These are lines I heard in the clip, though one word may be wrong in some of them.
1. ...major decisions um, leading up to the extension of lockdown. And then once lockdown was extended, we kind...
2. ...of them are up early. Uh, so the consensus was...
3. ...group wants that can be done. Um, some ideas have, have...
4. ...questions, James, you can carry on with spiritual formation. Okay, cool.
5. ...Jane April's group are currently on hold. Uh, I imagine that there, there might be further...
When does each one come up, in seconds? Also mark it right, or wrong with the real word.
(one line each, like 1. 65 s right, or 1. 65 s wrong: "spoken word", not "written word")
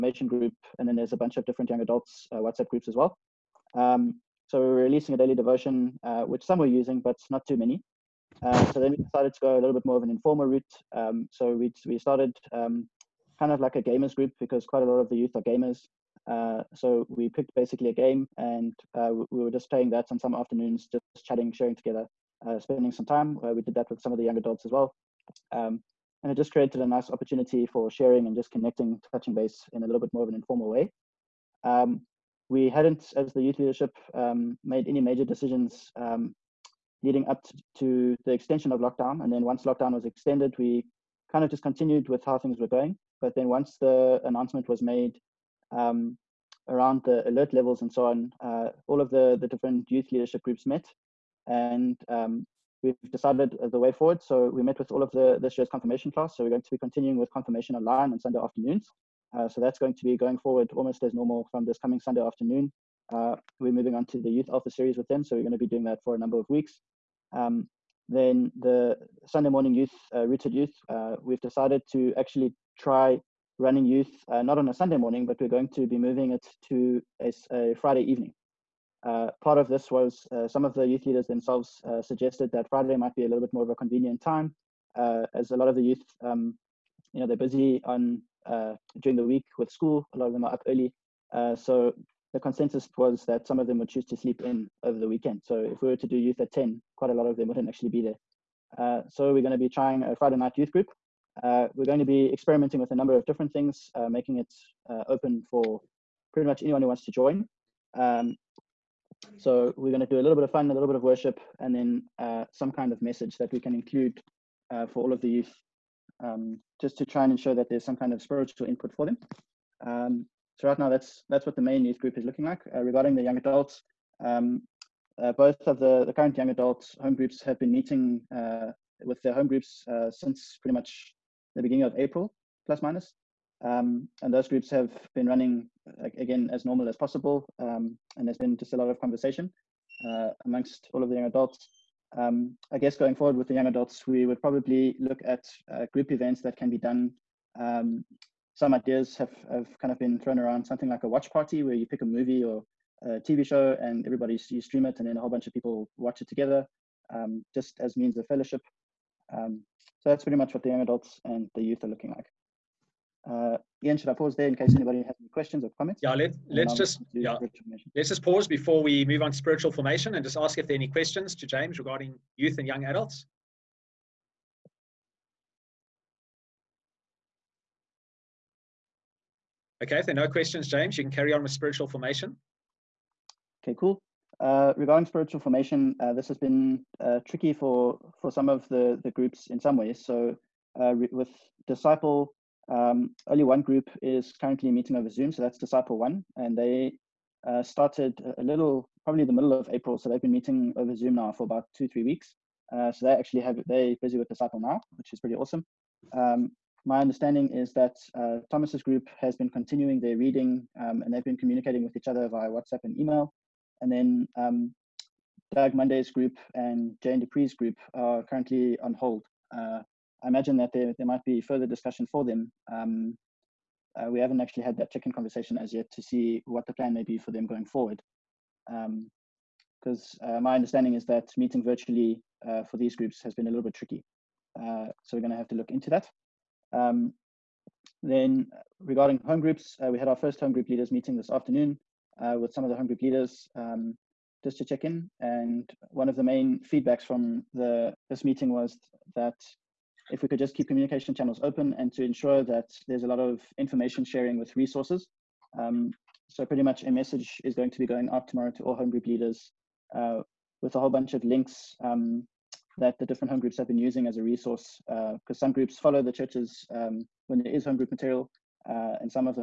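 1. 35 s right
2. 90 s right
3. 145 s wrong: "events", not "wants"
4. 180 s right
5. 217 s wrong: "Dupree", not "April".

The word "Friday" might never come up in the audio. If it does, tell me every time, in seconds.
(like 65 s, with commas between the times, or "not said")
77 s, 82 s, 100 s.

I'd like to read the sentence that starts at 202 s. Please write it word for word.
Uh, so they actually have they're busy with Disciple now, which is pretty awesome.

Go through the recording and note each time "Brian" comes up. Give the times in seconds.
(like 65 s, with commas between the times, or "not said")
not said.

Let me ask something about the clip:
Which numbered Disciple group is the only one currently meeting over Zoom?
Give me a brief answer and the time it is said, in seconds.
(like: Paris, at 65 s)
Disciple 1, at 195 s.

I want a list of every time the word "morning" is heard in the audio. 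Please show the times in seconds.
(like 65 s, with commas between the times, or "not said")
69 s, 74 s.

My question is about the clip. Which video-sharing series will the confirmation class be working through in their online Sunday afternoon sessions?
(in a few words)
Youth Alpha.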